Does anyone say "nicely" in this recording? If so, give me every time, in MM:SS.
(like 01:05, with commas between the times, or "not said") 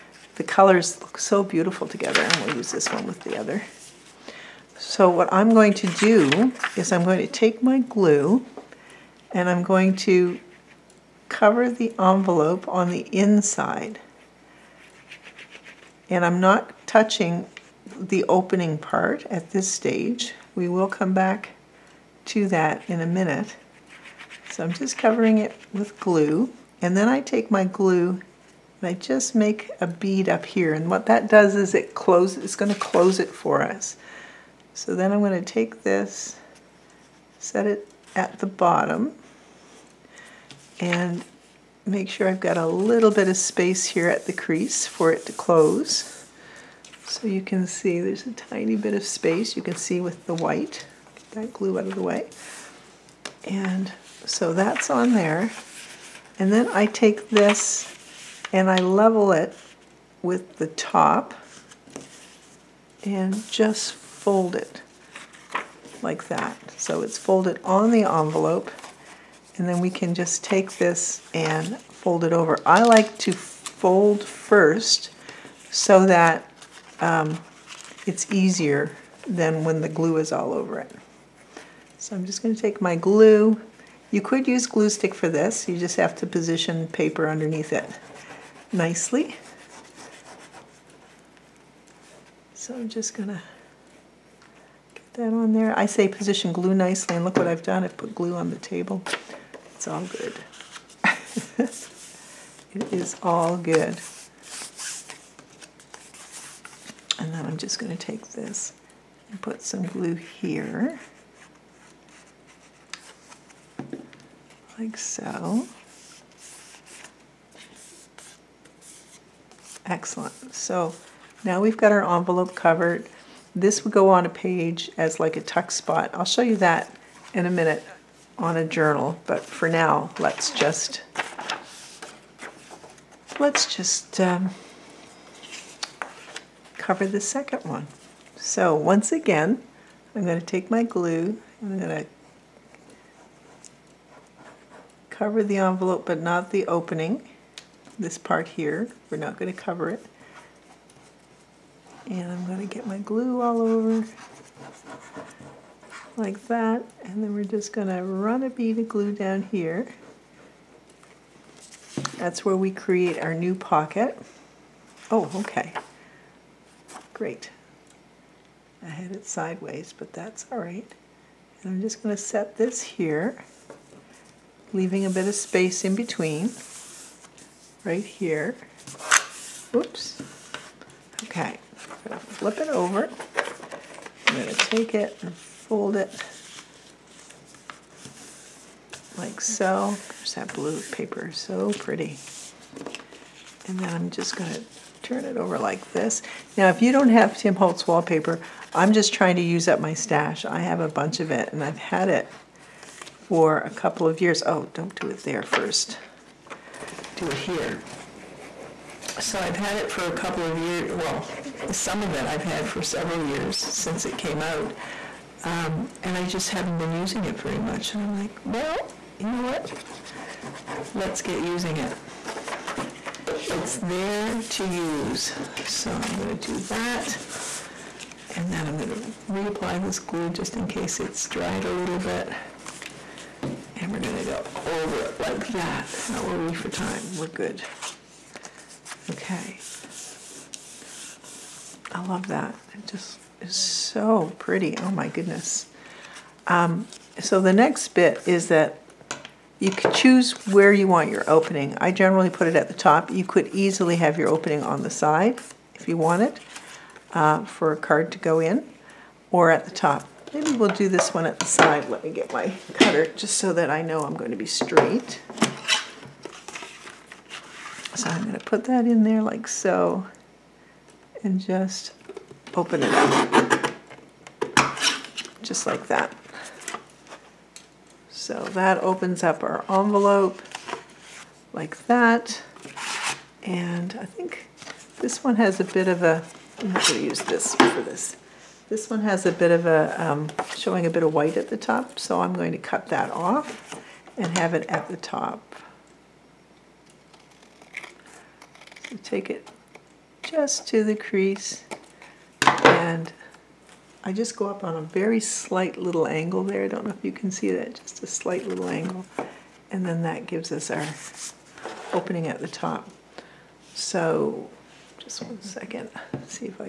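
01:28, 01:36.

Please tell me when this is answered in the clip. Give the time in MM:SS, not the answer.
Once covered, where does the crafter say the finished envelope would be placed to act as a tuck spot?
02:04.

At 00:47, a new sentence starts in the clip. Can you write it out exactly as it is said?
So you can see there's a tiny bit of space you can see with the white.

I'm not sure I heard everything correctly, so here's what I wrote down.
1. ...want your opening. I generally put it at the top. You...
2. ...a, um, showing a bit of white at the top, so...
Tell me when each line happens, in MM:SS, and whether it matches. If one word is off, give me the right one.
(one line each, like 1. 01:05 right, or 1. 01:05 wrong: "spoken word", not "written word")
1. 04:10 right
2. 04:49 right.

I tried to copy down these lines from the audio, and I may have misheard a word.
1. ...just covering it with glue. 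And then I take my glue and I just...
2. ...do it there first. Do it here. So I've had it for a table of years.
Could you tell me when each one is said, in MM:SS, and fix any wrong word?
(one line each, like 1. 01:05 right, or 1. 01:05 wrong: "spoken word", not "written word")
1. 00:24 right
2. 03:24 wrong: "couple", not "table".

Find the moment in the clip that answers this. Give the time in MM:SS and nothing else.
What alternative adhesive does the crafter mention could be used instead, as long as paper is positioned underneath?
01:24.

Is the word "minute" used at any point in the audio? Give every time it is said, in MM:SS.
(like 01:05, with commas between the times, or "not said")
00:23, 02:07.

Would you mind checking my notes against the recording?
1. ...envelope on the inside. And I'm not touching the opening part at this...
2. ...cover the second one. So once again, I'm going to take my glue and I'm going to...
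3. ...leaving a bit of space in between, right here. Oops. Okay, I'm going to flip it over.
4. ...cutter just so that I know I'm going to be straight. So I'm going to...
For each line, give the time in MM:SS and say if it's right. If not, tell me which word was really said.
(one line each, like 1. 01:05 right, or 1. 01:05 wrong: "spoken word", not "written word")
1. 00:11 right
2. 02:16 right
3. 02:54 right
4. 04:22 right.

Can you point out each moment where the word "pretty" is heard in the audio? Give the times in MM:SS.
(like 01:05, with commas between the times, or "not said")
03:11, 04:04.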